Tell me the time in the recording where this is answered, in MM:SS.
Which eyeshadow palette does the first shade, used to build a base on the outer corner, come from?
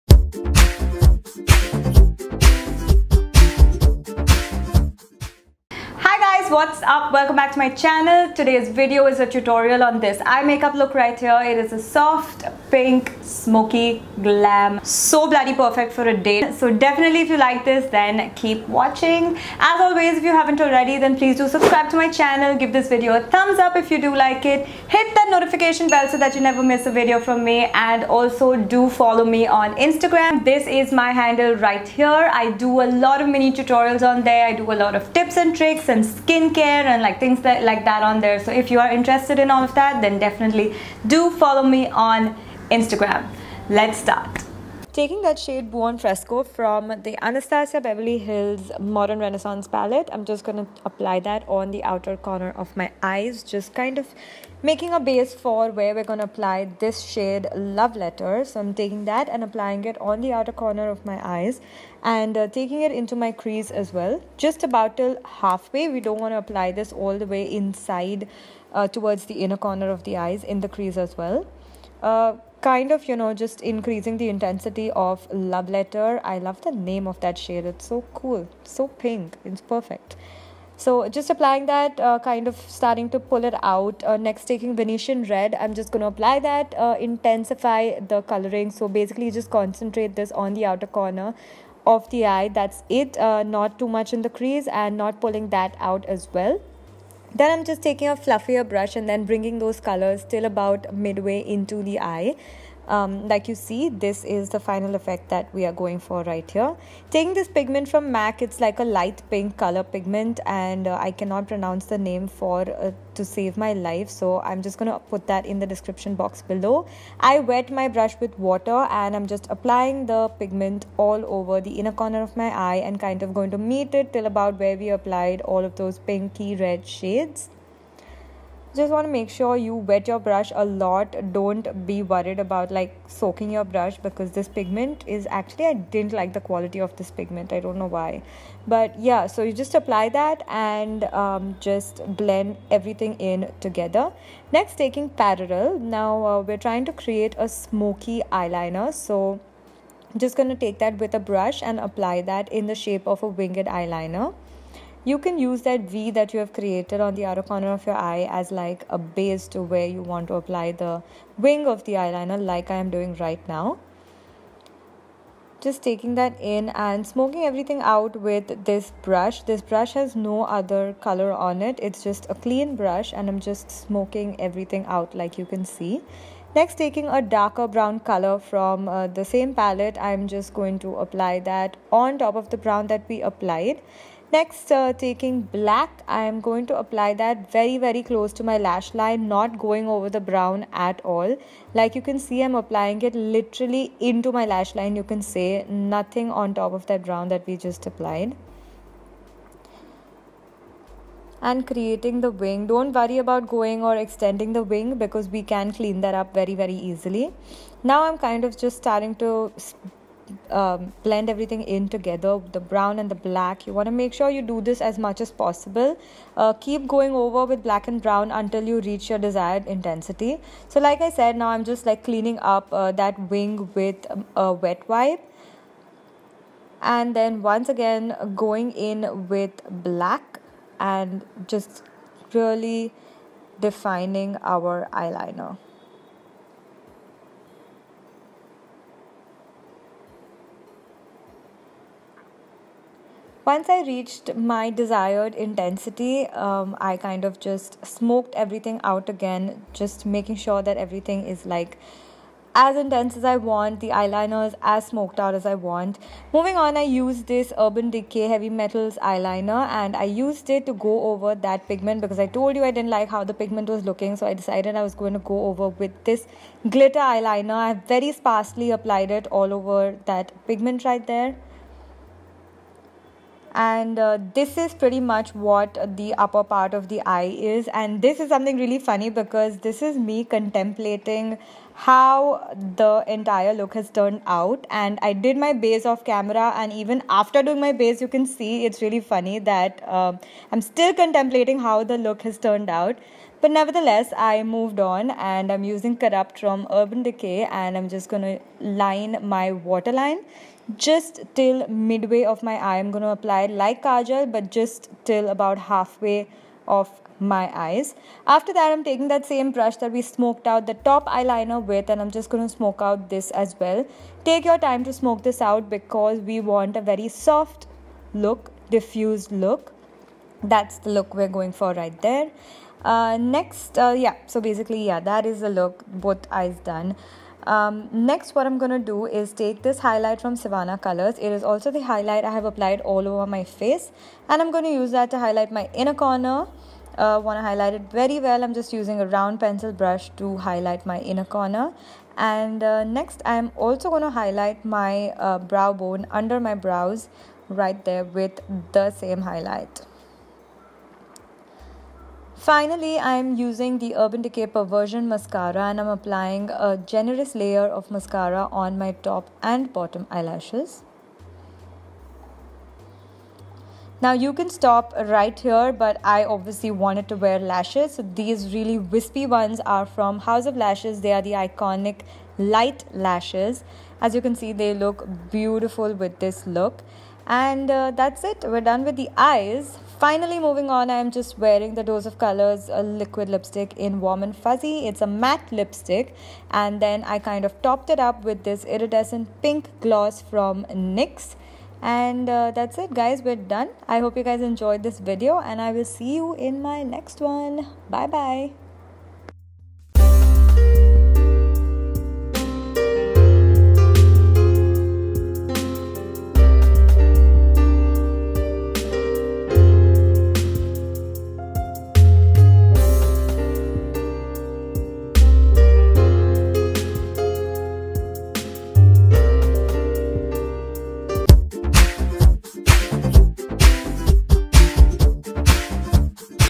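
00:48.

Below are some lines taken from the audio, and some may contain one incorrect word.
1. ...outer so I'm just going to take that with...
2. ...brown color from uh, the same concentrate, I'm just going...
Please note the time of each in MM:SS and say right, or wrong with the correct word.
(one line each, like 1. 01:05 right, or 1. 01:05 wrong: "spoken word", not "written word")
1. 02:28 wrong: "eyeliner", not "outer"
2. 02:57 wrong: "palette", not "concentrate".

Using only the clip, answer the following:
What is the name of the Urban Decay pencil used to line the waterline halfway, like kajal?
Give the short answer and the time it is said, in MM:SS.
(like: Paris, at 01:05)
Corrupt, at 04:55.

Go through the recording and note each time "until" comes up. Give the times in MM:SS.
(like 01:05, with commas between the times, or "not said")
03:38.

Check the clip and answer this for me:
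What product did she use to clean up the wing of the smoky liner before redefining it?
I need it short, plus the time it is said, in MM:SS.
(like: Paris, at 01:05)
a wet wipe, at 03:44.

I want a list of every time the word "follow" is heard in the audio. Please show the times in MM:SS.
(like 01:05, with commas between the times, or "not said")
00:28, 00:41.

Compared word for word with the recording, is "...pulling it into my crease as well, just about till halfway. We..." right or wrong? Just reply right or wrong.
wrong.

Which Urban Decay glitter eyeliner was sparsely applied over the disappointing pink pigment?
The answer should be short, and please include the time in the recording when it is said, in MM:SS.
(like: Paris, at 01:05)
Heavy Metals, at 04:18.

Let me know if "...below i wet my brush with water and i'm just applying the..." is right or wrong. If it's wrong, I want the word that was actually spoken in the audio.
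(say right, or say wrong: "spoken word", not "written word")
right.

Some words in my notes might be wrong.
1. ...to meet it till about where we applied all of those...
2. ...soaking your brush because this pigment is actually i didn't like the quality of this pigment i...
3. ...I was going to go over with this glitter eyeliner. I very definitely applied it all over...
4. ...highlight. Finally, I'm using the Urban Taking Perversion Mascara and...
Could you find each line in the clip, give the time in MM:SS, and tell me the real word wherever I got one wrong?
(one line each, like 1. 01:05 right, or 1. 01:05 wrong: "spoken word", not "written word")
1. 02:03 right
2. 02:13 right
3. 04:24 wrong: "sparsely", not "definitely"
4. 05:49 wrong: "Decay", not "Taking".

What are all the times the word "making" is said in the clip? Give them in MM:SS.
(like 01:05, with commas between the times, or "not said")
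00:54, 04:10.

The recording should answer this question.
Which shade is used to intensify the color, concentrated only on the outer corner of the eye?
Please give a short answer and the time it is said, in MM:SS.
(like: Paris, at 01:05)
Venetian Red, at 01:24.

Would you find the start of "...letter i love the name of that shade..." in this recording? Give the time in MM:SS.
01:15.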